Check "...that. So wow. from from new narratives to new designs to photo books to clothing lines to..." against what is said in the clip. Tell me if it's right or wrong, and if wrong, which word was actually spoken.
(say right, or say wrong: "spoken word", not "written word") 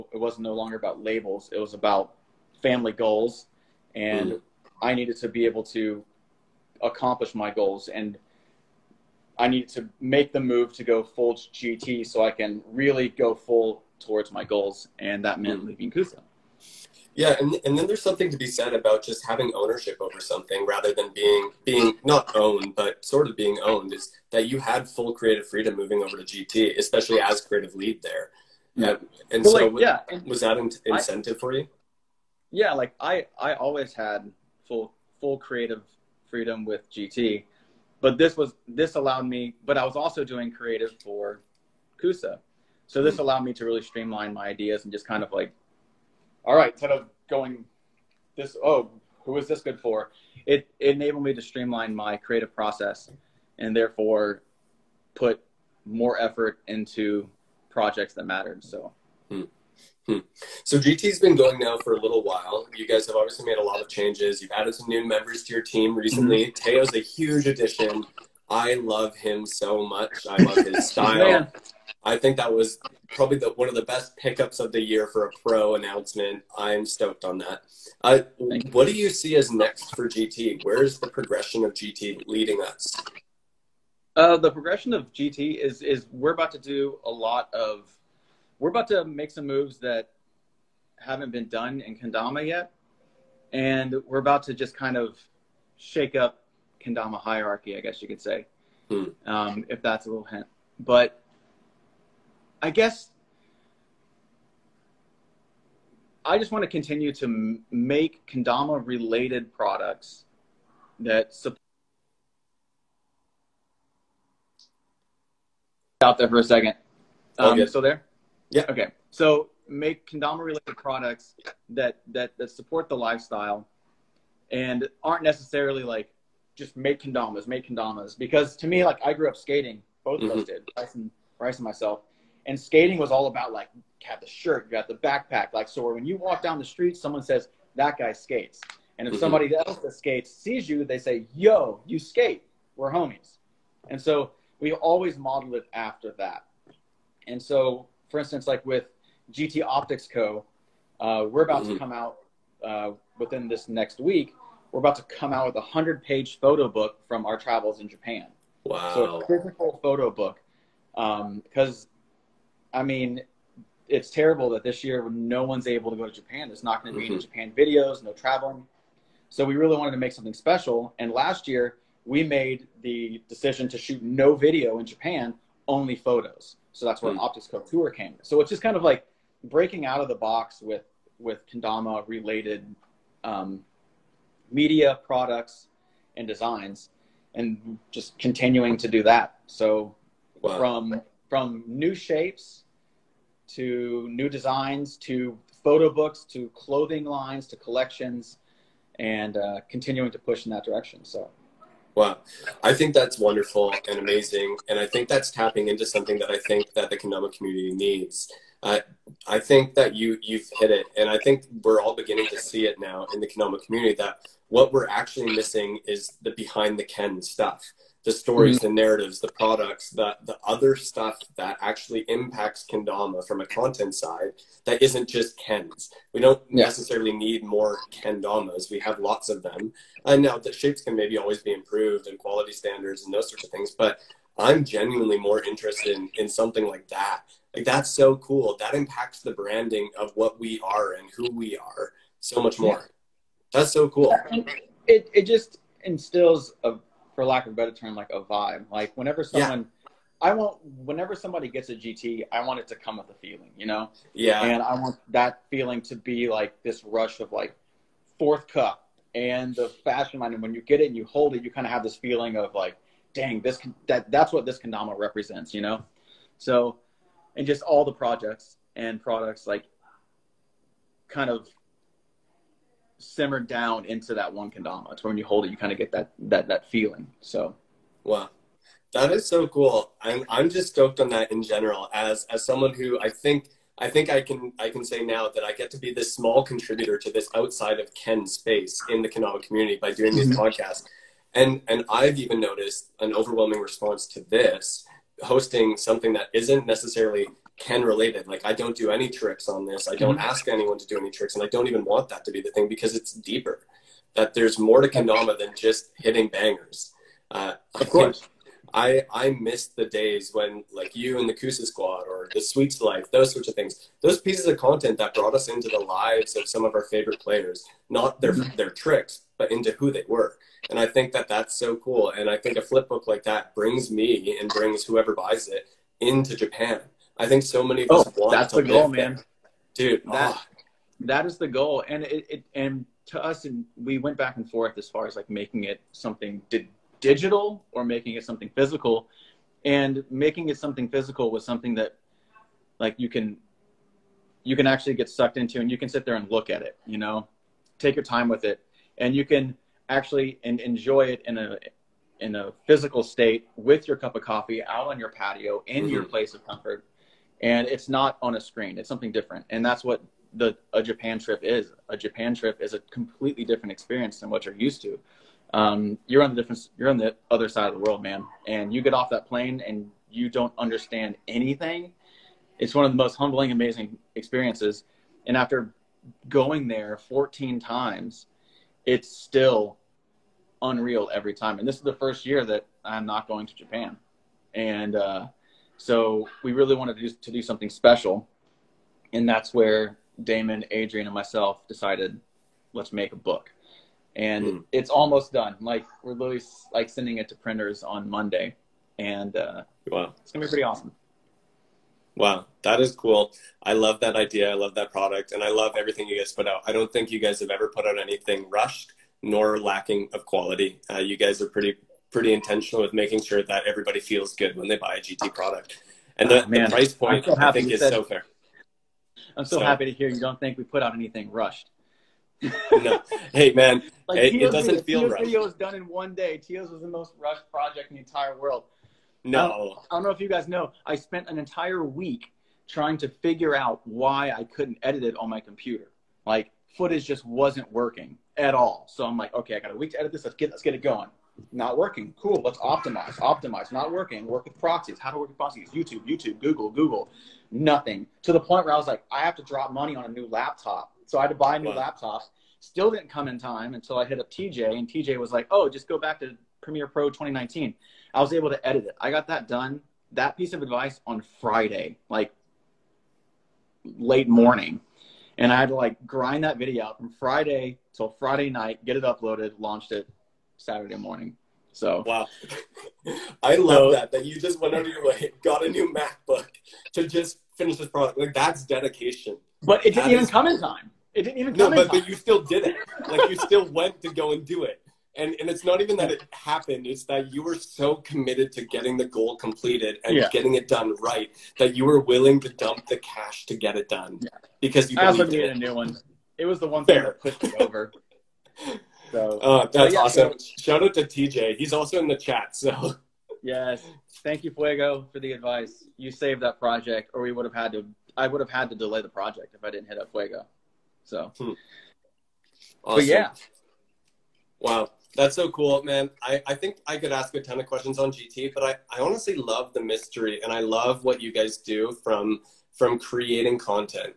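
wrong: "shapes", not "narratives".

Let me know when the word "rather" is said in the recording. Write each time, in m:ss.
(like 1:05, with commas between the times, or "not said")
0:20.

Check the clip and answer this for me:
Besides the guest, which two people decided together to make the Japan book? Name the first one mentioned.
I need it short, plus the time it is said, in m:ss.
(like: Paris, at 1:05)
Damon, at 6:30.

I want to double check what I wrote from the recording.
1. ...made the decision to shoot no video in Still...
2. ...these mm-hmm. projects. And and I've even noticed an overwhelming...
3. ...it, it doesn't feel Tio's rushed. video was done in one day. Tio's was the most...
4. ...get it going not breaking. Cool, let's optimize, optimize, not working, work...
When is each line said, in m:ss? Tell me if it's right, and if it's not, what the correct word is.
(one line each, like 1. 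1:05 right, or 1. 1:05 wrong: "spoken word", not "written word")
1. 2:52 wrong: "Japan", not "Still"
2. 4:50 wrong: "podcasts", not "projects"
3. 7:04 right
4. 7:20 wrong: "working", not "breaking".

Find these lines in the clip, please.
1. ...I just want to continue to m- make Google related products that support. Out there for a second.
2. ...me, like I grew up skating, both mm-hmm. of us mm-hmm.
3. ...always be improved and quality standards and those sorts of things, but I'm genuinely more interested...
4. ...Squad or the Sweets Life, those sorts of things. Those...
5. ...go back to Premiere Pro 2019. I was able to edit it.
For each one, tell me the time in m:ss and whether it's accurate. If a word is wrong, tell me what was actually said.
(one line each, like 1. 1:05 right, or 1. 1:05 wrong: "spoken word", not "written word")
1. 1:46 wrong: "Kendama", not "Google"
2. 2:08 right
3. 3:51 right
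4. 5:11 right
5. 7:35 right.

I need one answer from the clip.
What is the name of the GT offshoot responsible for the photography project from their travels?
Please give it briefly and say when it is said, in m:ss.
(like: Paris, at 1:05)
GT Optics Co, at 2:29.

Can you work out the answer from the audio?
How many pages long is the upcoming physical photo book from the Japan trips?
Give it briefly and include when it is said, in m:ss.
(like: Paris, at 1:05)
100, at 2:35.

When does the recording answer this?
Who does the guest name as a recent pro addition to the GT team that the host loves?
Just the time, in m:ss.
1:06.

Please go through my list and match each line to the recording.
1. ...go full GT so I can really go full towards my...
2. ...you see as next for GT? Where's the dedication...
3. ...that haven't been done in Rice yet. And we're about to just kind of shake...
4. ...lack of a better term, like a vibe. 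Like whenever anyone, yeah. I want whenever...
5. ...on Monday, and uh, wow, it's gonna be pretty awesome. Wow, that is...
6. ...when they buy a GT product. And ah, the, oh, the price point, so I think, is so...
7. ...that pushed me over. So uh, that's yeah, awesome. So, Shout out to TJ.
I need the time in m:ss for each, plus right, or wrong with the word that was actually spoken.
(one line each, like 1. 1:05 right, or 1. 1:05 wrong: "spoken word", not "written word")
1. 0:10 right
2. 1:18 wrong: "progression", not "dedication"
3. 1:29 wrong: "Kendama", not "Rice"
4. 4:07 wrong: "someone", not "anyone"
5. 6:37 right
6. 6:54 right
7. 8:17 right.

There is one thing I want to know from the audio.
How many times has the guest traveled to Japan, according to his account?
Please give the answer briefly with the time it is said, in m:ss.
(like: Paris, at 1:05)
14, at 6:16.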